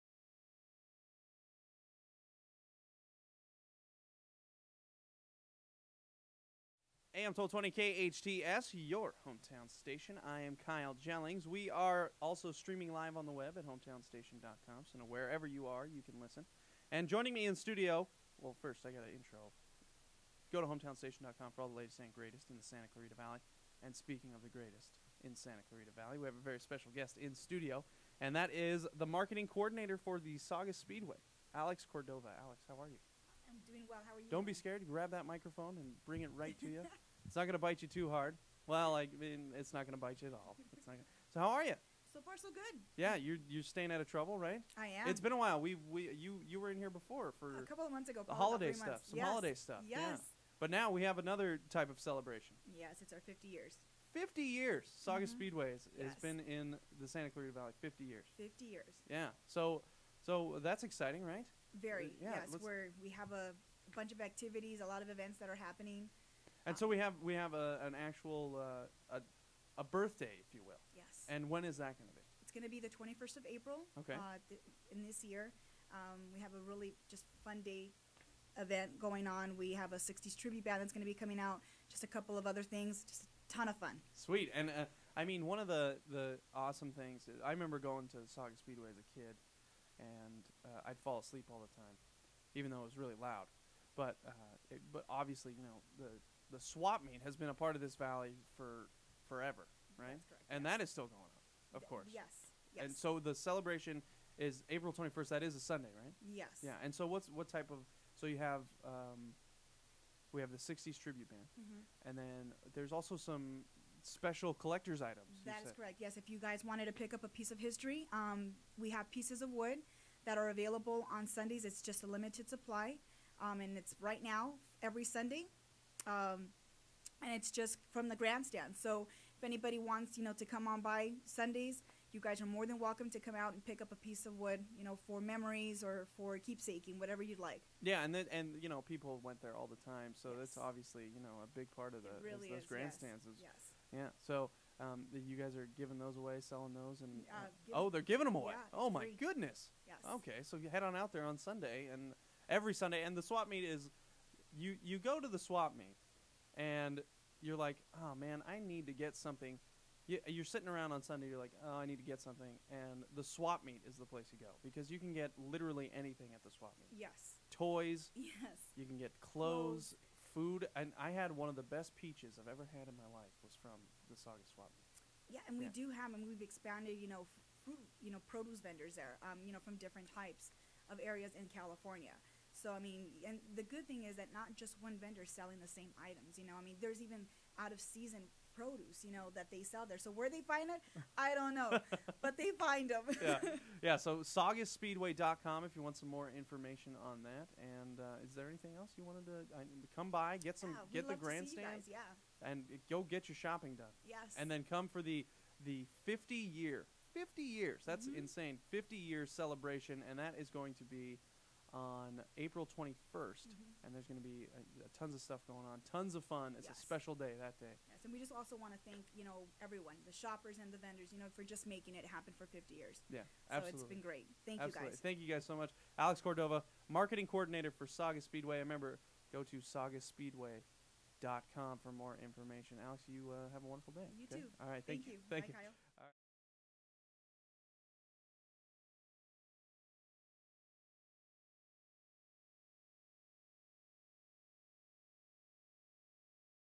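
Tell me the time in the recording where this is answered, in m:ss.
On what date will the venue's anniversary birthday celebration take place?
1:12.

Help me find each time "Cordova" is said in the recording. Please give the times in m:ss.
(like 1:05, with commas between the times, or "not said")
0:31, 3:46.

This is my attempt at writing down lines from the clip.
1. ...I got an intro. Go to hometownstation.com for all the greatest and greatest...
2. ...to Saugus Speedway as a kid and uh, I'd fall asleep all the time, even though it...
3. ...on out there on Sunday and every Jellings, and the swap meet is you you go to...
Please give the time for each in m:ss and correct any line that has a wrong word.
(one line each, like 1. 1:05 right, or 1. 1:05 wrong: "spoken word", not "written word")
1. 0:18 wrong: "latest", not "greatest"
2. 1:28 right
3. 2:30 wrong: "Sunday", not "Jellings".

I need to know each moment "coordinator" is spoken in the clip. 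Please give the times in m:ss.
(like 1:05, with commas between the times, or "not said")
0:29, 3:47.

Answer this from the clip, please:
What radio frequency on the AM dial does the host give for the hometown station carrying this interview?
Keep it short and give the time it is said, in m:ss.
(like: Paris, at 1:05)
1220, at 0:07.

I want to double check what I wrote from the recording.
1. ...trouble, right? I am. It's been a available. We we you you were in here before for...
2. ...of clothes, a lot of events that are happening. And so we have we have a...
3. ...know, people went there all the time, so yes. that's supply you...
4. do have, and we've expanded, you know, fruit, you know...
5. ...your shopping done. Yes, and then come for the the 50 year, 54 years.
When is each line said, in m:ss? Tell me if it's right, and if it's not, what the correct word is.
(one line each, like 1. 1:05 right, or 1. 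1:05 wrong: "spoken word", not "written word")
1. 0:44 wrong: "while", not "available"
2. 1:04 wrong: "activities", not "clothes"
3. 2:18 wrong: "obviously", not "supply"
4. 2:55 right
5. 3:23 wrong: "50", not "54".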